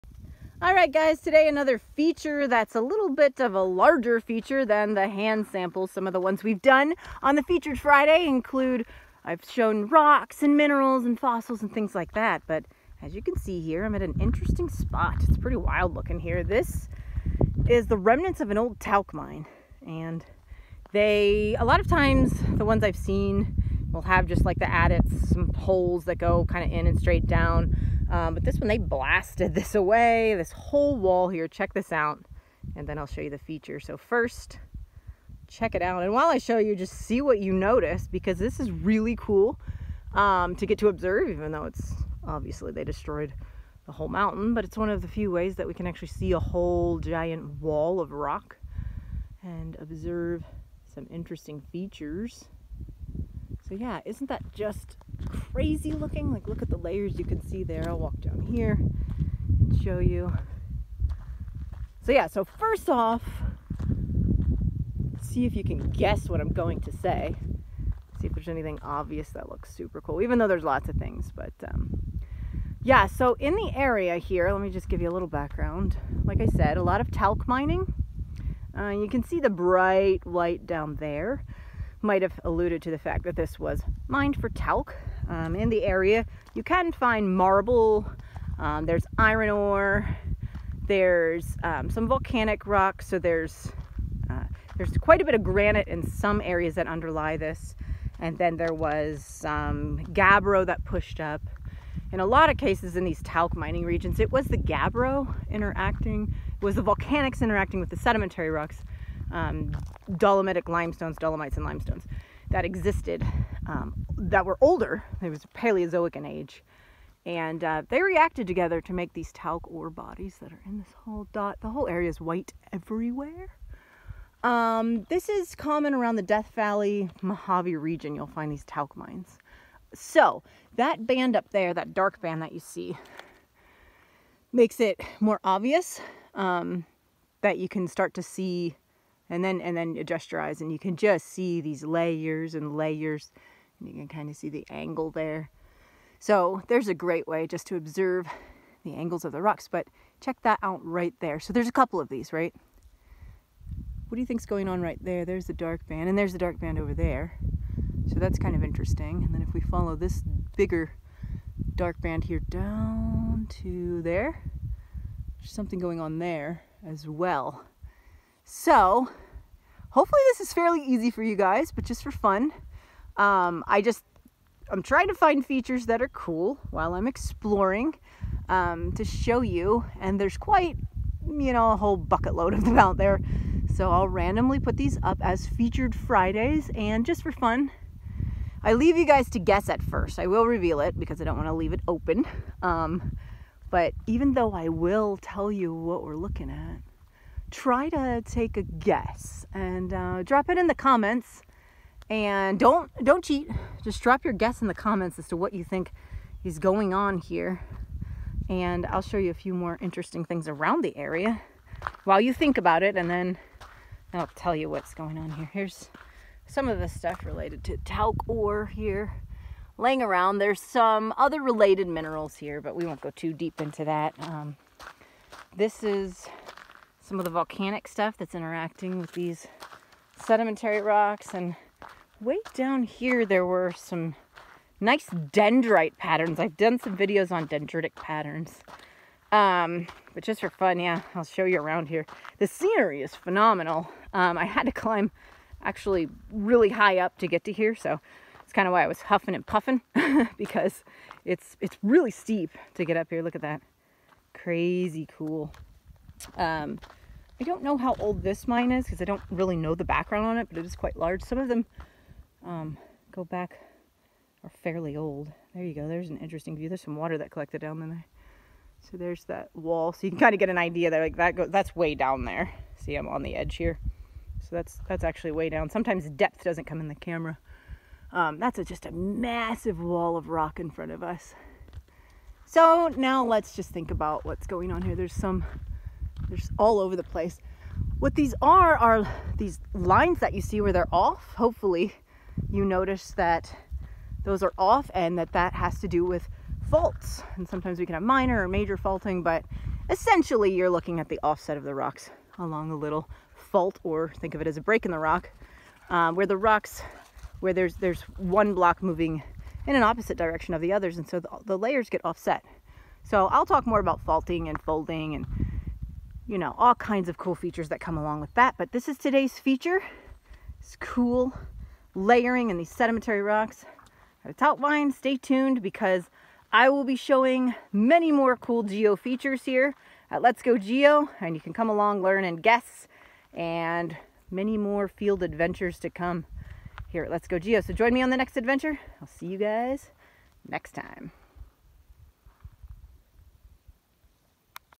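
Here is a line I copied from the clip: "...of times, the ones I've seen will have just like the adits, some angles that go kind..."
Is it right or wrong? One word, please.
wrong.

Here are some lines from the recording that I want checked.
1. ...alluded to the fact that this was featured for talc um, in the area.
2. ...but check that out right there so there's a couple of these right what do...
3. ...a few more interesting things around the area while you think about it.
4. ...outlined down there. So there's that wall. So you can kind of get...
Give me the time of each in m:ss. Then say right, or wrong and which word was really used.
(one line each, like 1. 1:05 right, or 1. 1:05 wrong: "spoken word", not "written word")
1. 1:22 wrong: "mined", not "featured"
2. 2:29 right
3. 3:29 right
4. 4:27 wrong: "collected", not "outlined".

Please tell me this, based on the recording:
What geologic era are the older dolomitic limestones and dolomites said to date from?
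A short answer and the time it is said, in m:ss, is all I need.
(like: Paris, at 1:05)
Paleozoic, at 1:55.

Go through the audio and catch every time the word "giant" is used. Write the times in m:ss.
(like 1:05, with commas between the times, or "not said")
0:46.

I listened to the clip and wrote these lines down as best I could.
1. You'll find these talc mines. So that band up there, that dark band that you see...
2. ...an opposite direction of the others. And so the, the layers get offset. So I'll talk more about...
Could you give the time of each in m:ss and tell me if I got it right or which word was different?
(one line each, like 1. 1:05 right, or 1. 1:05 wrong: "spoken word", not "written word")
1. 2:08 right
2. 5:09 right.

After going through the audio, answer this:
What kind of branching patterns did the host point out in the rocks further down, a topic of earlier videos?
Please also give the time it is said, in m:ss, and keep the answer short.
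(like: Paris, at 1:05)
Dendrite patterns, at 3:55.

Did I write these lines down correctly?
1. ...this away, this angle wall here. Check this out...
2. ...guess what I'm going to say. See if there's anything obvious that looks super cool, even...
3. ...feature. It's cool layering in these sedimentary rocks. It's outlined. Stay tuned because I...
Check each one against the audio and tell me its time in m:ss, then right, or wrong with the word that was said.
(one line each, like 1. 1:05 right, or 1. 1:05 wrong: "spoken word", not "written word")
1. 0:29 wrong: "whole", not "angle"
2. 1:05 right
3. 5:19 right.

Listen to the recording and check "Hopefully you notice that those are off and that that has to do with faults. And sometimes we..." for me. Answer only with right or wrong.
right.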